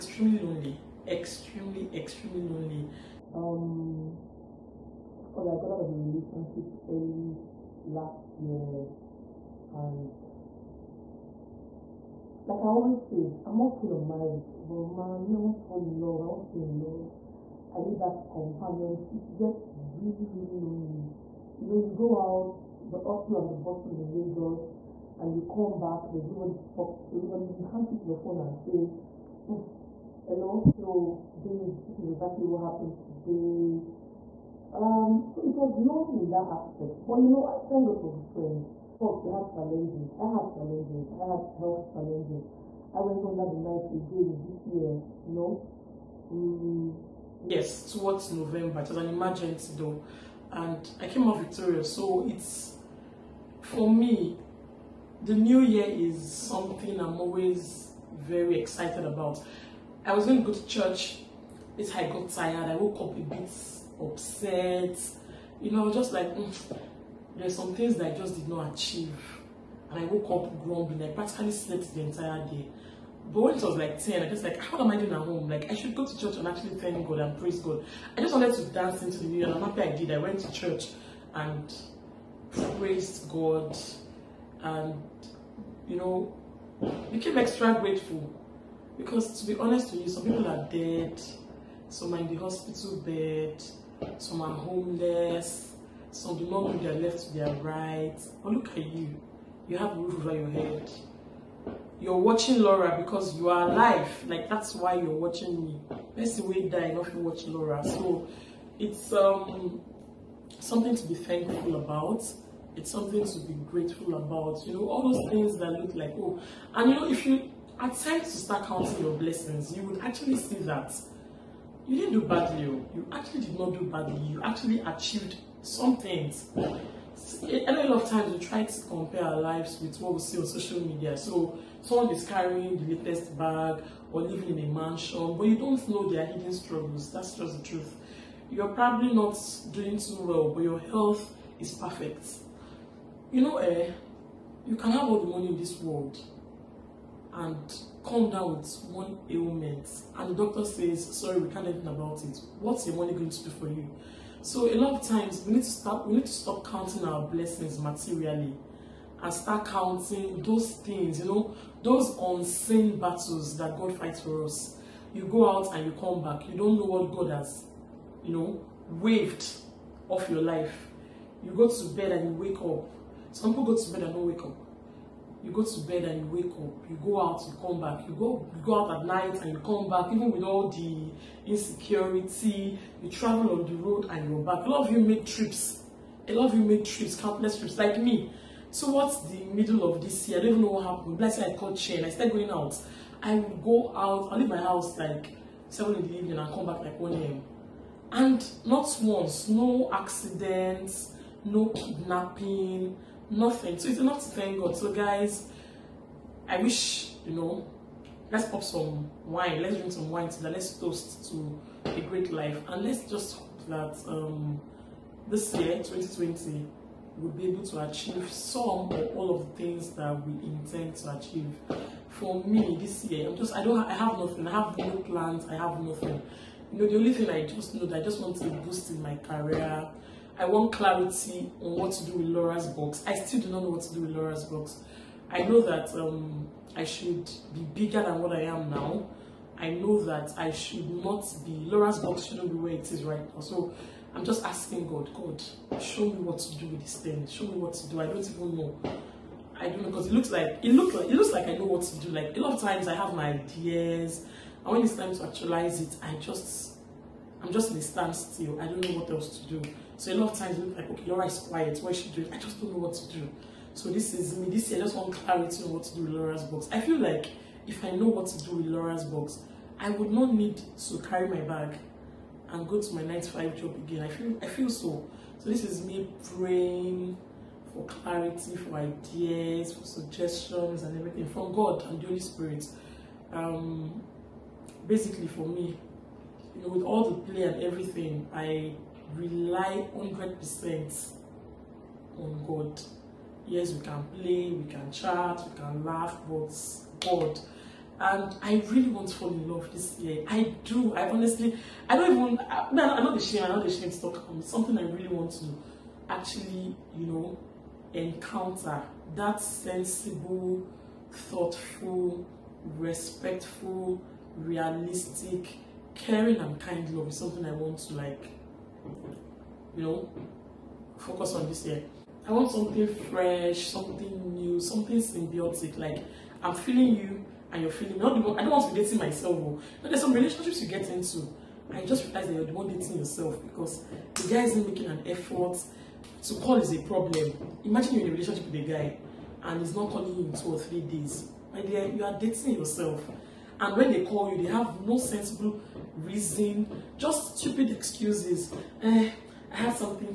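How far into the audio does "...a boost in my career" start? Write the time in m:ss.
3:48.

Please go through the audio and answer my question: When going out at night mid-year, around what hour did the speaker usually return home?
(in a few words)
1 am.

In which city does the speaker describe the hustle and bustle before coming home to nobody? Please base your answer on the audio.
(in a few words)
Lagos.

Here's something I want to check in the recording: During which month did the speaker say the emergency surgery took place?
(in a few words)
November.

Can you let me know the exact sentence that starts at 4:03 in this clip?
So I'm just asking God, God, show me what to do with this thing.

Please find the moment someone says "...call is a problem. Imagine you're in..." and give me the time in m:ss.
5:36.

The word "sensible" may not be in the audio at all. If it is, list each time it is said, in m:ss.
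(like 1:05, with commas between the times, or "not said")
5:09, 5:44.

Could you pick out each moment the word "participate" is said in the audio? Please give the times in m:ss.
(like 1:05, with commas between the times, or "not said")
not said.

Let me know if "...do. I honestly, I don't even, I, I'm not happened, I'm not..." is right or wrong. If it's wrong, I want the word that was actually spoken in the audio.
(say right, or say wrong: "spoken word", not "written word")
wrong: "ashamed", not "happened".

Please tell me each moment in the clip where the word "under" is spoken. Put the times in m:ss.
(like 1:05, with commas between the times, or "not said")
0:43.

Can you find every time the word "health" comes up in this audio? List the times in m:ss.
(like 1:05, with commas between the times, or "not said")
0:41, 2:20.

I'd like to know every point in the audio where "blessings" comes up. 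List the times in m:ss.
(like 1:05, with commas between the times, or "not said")
1:59, 2:37.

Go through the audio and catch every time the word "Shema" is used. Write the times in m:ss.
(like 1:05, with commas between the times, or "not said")
not said.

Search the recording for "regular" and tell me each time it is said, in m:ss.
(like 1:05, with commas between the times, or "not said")
not said.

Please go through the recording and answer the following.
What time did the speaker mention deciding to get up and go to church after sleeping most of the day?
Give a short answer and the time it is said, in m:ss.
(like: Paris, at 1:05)
10, at 1:14.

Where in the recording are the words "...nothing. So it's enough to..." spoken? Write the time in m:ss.
3:23.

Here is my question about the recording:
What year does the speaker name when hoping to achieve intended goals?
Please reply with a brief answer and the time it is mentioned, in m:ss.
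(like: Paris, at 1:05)
2020, at 3:35.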